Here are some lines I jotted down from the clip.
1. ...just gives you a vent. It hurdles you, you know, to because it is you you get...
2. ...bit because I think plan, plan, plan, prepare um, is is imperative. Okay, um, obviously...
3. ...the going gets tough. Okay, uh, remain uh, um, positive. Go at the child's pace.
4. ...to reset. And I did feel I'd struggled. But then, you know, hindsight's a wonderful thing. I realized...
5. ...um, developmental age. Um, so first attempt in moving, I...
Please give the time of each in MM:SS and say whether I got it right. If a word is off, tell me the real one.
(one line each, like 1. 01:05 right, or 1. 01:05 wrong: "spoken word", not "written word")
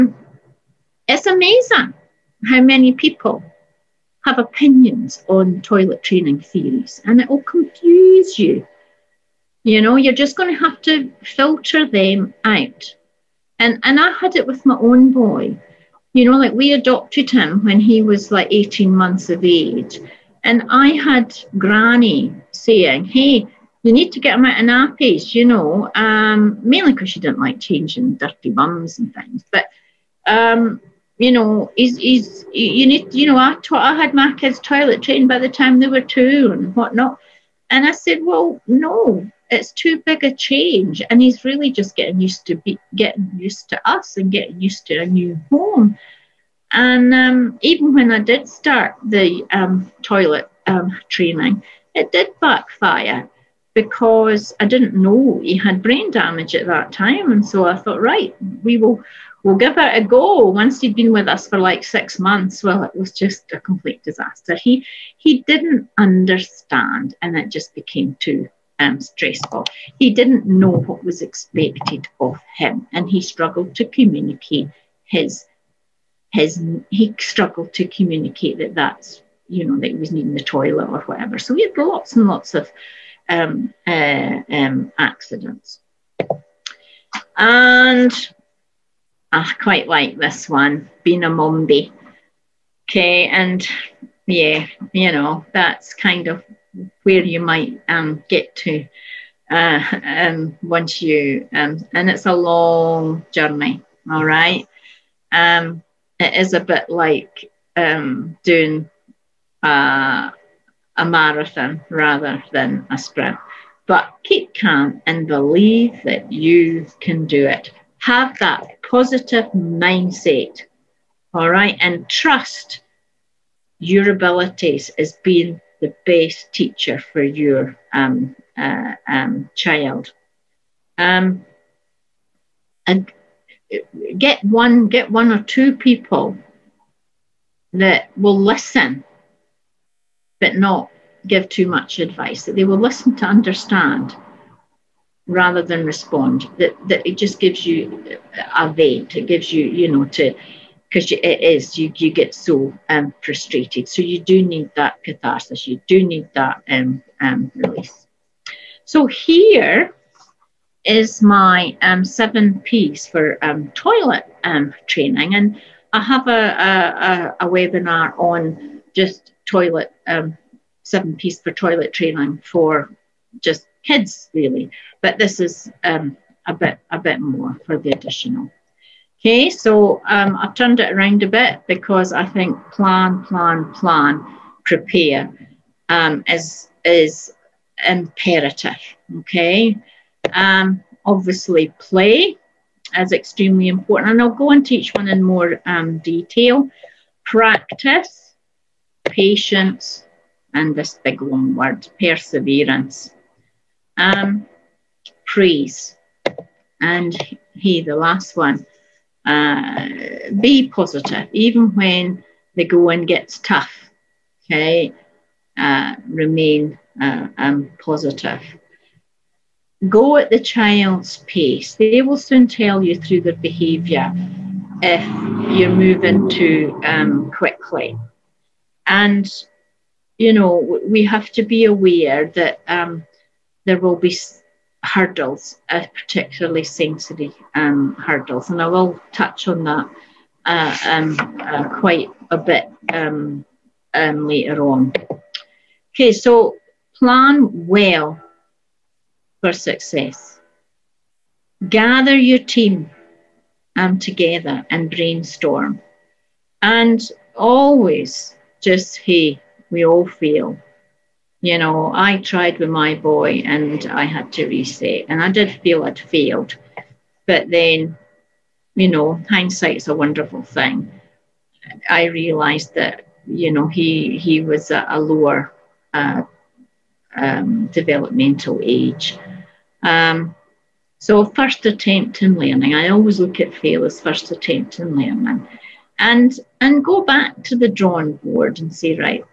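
1. 02:27 wrong: "gives", not "hurdles"
2. 03:01 right
3. 03:32 right
4. 04:24 wrong: "failed", not "struggled"
5. 04:37 wrong: "learning", not "moving".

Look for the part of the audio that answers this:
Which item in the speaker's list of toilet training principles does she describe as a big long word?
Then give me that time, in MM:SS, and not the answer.
03:22.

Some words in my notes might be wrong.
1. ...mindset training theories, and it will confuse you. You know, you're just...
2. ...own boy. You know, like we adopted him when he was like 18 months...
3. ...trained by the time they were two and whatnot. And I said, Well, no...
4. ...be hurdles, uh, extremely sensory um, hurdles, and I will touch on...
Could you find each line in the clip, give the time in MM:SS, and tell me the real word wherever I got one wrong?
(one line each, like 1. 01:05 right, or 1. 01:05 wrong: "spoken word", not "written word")
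1. 00:05 wrong: "toilet", not "mindset"
2. 00:14 right
3. 00:35 right
4. 03:53 wrong: "particularly", not "extremely".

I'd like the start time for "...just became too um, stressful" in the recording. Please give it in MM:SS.
01:07.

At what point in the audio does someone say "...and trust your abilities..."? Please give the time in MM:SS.
02:01.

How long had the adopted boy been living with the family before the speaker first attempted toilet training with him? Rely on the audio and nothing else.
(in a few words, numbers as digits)
6 months.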